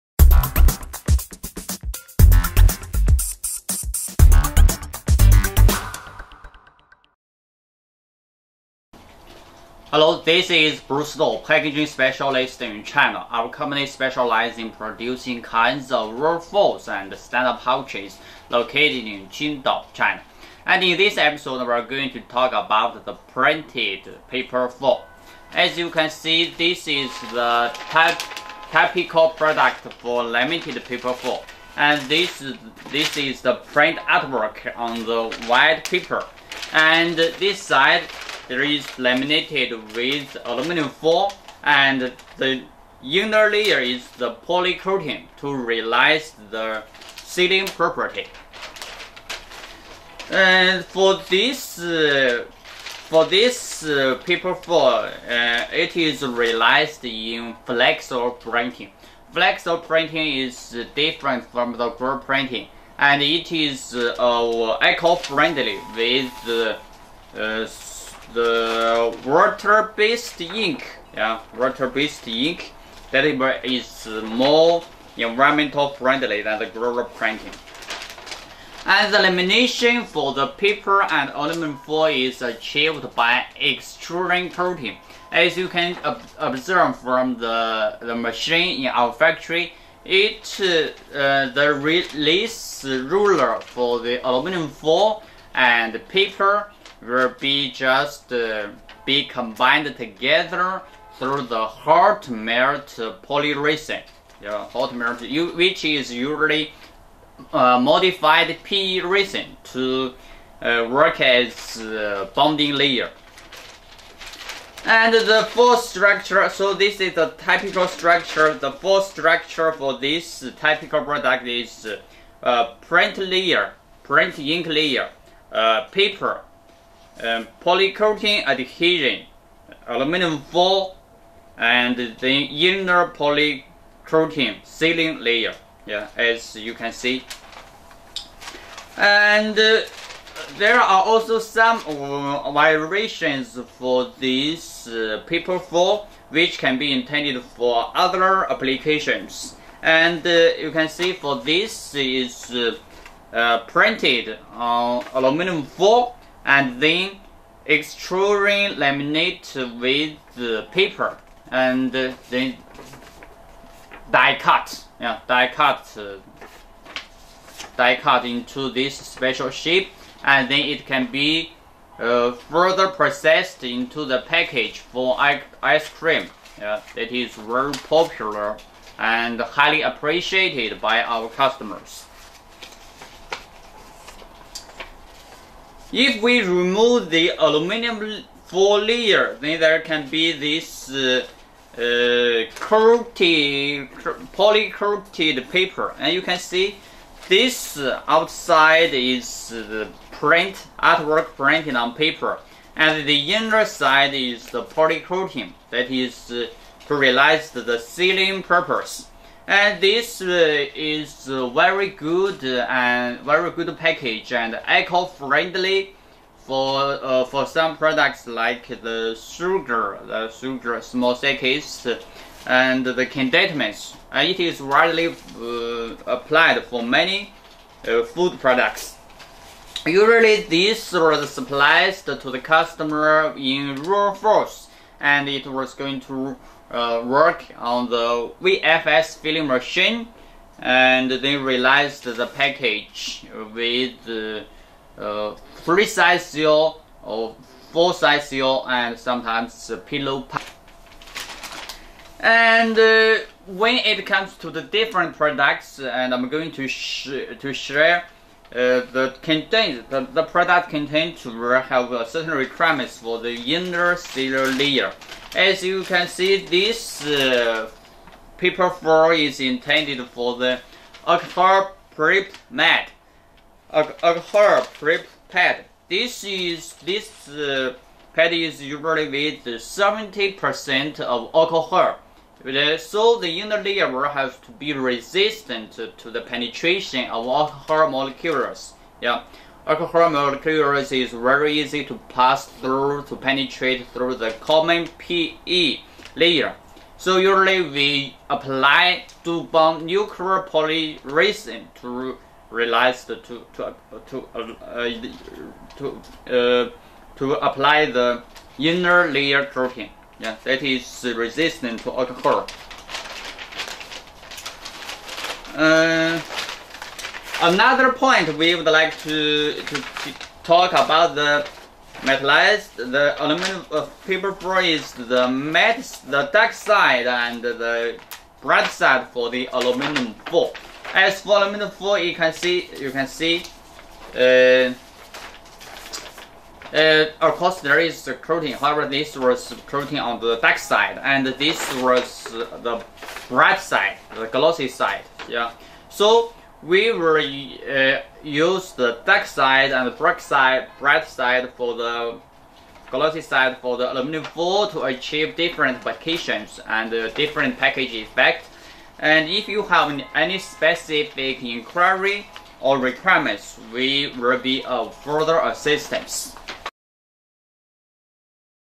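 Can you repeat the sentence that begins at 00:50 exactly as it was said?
And for this uh, for this uh, paper foil, uh, it is realized in flexo printing.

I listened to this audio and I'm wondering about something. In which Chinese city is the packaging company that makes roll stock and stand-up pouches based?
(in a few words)
Qingdao.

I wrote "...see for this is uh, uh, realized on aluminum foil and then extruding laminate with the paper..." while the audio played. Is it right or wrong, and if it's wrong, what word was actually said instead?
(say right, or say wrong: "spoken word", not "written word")
wrong: "printed", not "realized".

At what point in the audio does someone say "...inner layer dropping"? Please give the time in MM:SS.
05:08.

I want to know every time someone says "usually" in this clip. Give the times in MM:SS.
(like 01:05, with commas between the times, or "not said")
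01:46, 03:49, 04:38, 04:57.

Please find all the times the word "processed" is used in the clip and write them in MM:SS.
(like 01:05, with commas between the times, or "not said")
02:52.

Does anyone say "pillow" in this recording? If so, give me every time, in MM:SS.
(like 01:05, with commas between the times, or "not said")
04:09.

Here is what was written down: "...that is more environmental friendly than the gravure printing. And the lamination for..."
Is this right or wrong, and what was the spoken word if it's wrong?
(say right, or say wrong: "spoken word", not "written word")
right.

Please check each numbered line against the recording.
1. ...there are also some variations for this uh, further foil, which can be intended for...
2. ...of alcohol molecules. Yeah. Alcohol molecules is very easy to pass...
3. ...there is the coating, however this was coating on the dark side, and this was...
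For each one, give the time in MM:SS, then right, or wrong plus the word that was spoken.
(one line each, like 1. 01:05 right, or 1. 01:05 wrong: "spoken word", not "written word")
1. 02:20 wrong: "paper", not "further"
2. 04:47 right
3. 05:37 right.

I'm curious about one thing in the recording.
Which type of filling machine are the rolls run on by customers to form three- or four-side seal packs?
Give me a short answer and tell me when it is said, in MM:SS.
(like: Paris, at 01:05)
VFS, at 03:58.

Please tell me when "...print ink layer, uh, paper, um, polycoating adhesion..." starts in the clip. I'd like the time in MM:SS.
02:04.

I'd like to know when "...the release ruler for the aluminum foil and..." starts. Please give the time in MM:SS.
01:31.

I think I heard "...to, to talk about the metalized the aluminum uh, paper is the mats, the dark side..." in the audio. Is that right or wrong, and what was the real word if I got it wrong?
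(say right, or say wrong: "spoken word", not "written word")
right.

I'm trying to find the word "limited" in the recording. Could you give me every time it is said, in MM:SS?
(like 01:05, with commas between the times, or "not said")
00:30.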